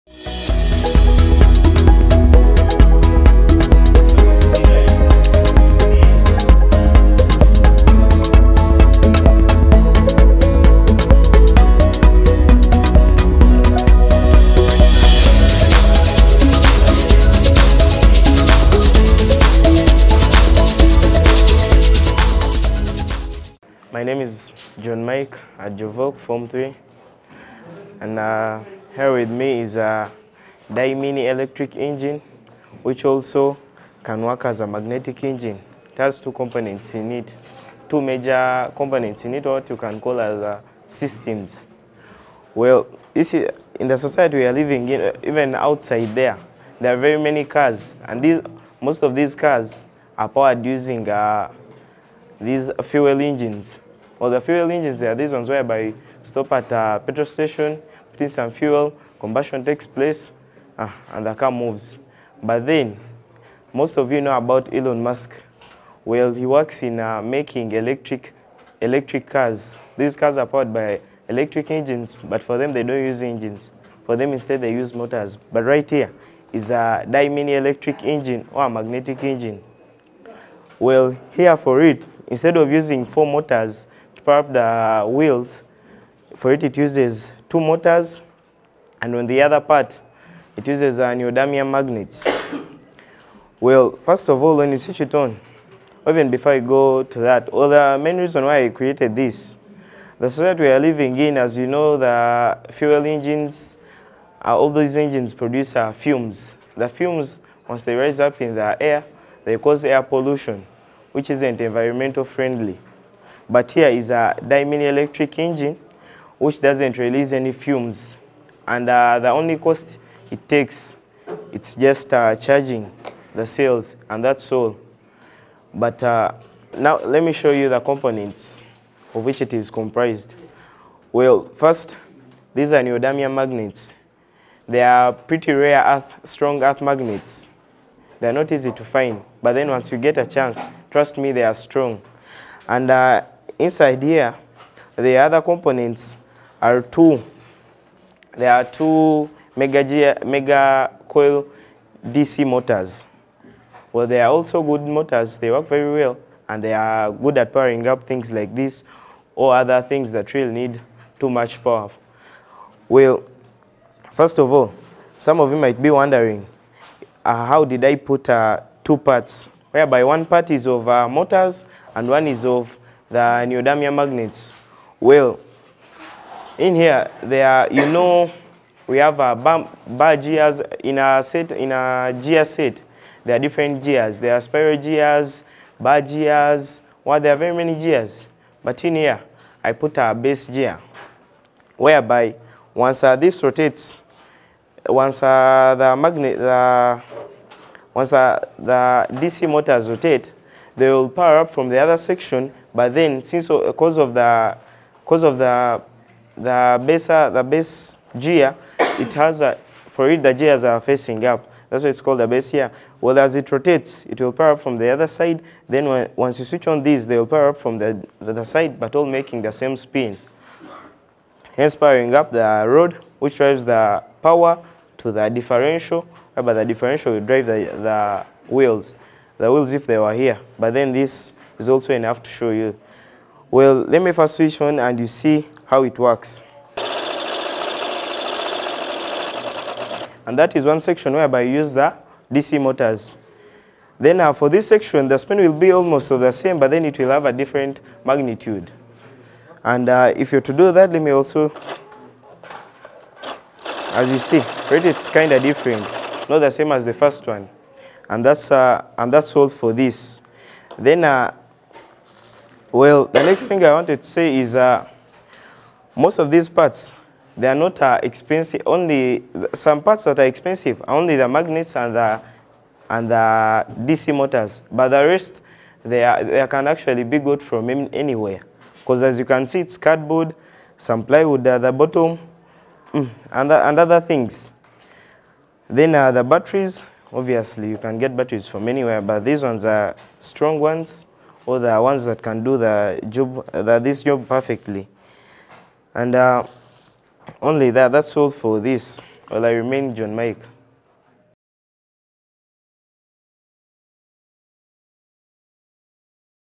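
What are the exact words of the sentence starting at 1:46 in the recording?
The fumes, once they rise up in the air, they cause air pollution, which isn't environmental friendly.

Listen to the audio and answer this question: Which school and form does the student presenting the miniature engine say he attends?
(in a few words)
Jovok Form 3.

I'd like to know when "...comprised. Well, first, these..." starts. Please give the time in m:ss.
2:09.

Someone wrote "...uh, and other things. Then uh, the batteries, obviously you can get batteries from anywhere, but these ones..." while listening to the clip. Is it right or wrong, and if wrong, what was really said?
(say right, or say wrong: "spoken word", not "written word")
right.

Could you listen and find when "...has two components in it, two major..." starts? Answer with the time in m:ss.
0:35.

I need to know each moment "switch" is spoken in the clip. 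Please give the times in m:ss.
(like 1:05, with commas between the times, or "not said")
1:34, 3:36, 3:54.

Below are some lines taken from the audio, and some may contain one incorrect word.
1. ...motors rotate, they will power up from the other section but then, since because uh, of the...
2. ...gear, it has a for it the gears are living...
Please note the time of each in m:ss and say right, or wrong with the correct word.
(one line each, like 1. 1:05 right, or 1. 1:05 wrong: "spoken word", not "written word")
1. 3:19 right
2. 3:28 wrong: "facing", not "living".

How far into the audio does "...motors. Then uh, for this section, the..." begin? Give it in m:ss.
4:02.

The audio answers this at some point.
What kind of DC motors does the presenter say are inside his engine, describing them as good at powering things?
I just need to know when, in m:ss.
2:30.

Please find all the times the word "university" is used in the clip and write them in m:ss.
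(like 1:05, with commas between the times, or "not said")
not said.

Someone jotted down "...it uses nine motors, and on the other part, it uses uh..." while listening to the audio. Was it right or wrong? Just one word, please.
wrong.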